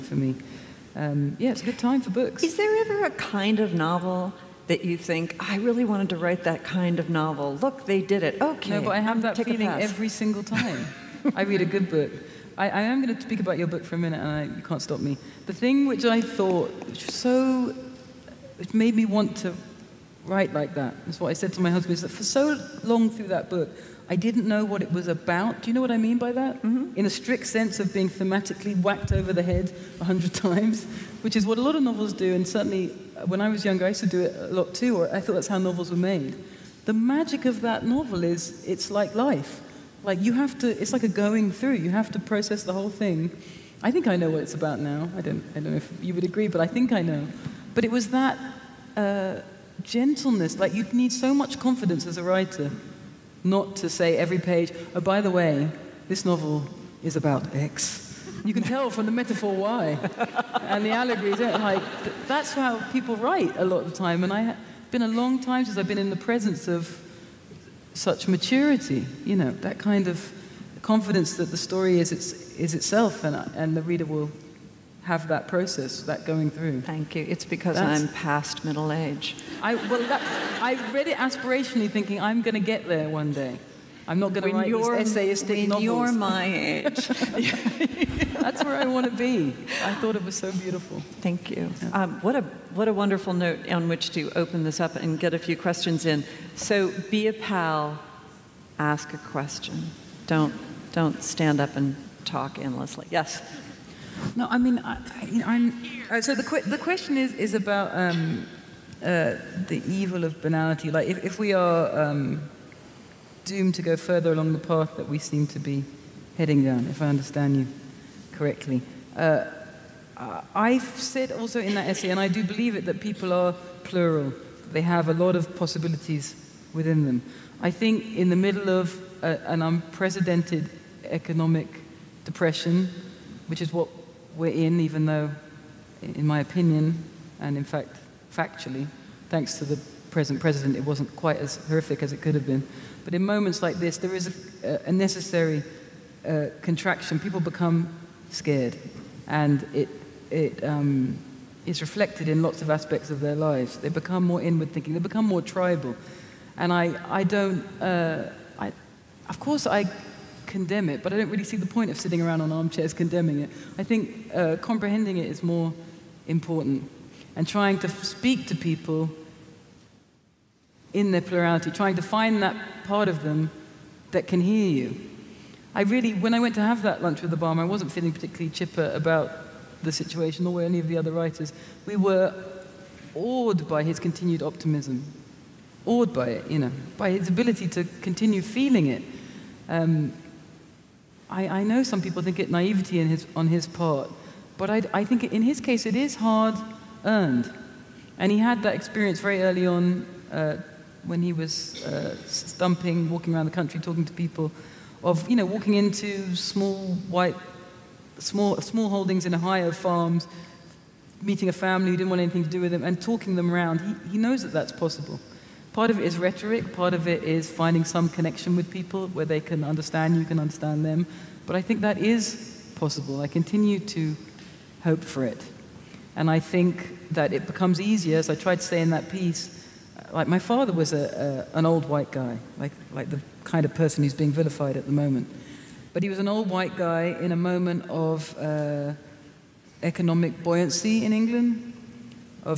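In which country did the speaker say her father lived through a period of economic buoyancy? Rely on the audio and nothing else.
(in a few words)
England.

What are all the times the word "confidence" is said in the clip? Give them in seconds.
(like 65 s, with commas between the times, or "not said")
51 s, 70 s.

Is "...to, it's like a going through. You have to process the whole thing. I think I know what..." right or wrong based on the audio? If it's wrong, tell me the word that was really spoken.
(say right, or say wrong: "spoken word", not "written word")
right.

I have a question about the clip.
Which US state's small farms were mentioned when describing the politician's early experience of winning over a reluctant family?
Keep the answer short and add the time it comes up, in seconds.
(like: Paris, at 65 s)
Ohio, at 209 s.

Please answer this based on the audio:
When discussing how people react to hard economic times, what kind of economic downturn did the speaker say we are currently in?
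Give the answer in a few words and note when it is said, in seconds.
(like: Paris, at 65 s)
Unprecedented economic depression, at 129 s.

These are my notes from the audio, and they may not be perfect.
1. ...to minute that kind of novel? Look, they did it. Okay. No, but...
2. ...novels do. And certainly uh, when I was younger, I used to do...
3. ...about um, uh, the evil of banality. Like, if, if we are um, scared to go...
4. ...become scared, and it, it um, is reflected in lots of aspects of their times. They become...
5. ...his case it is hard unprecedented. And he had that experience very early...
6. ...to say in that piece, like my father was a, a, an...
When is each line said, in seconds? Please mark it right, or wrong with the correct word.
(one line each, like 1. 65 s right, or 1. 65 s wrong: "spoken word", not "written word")
1. 6 s wrong: "write", not "minute"
2. 31 s right
3. 107 s wrong: "doomed", not "scared"
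4. 147 s wrong: "lives", not "times"
5. 195 s wrong: "earned", not "unprecedented"
6. 228 s right.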